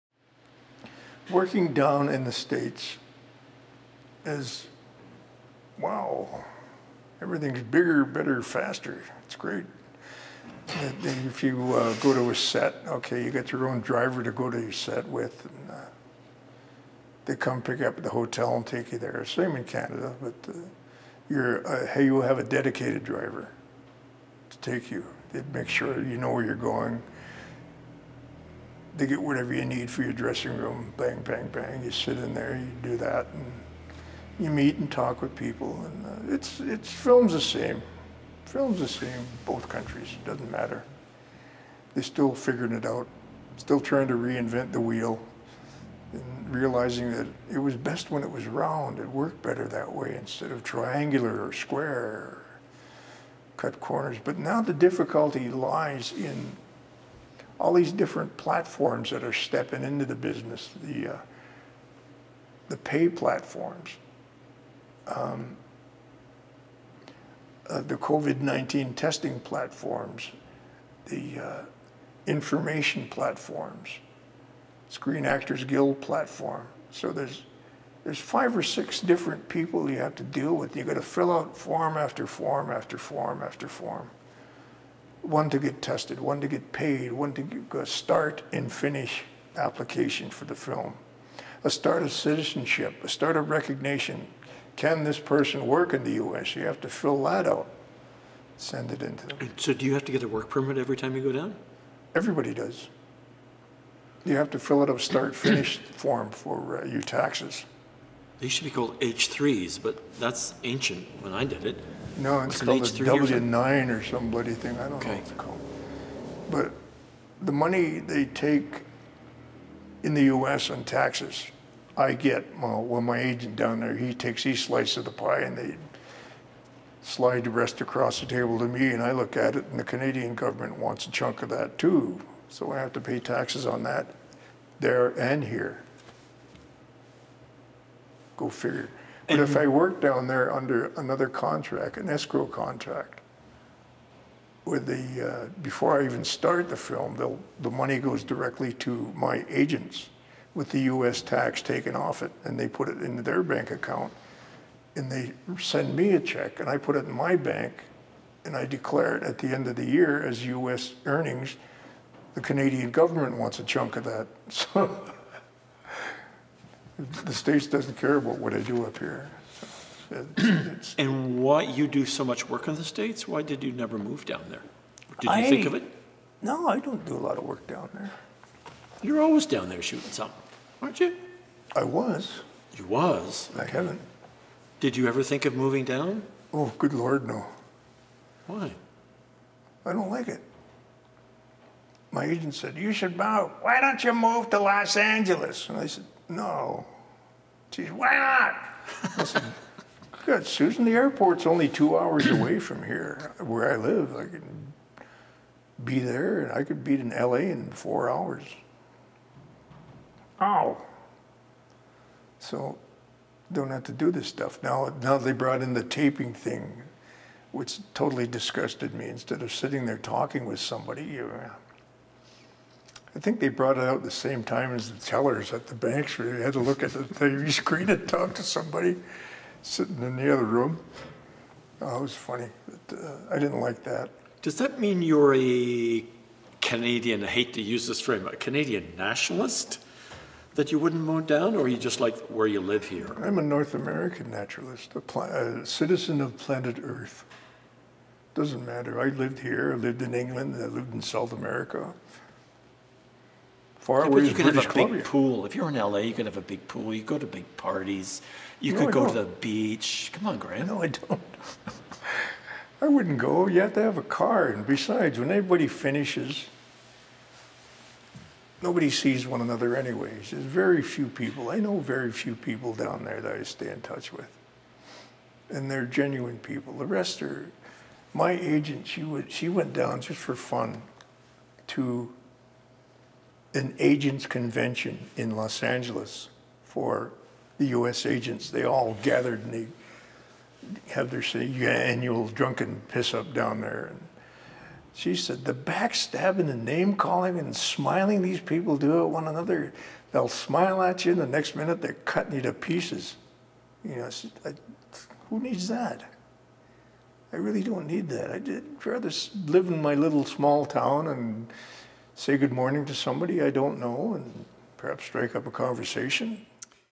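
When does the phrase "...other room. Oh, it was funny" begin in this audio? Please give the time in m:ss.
3:50.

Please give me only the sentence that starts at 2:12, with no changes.
So I have to pay taxes on that there and here.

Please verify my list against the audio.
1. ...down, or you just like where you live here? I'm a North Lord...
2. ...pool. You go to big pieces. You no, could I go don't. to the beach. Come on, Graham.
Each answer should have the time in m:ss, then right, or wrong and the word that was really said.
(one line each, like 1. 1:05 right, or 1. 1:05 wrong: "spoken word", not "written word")
1. 4:01 wrong: "American", not "Lord"
2. 4:16 wrong: "parties", not "pieces".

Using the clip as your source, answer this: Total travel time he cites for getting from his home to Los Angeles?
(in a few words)
4 hours.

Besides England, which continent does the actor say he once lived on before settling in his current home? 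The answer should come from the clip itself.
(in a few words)
South America.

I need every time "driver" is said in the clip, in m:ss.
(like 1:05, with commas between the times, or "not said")
0:13, 0:23.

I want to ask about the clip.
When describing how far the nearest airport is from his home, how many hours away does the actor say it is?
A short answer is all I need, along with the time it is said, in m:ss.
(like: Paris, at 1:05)
2, at 3:21.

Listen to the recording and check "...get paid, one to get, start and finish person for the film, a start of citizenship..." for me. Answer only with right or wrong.
wrong.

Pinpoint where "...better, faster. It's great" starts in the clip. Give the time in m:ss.
0:08.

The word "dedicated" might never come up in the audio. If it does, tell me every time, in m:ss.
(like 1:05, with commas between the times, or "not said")
0:22.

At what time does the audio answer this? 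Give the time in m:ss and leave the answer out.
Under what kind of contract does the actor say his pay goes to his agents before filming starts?
2:22.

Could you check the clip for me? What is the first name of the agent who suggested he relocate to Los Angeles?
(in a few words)
Susan.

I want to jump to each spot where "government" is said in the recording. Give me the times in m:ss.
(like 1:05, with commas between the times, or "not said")
2:10, 2:42.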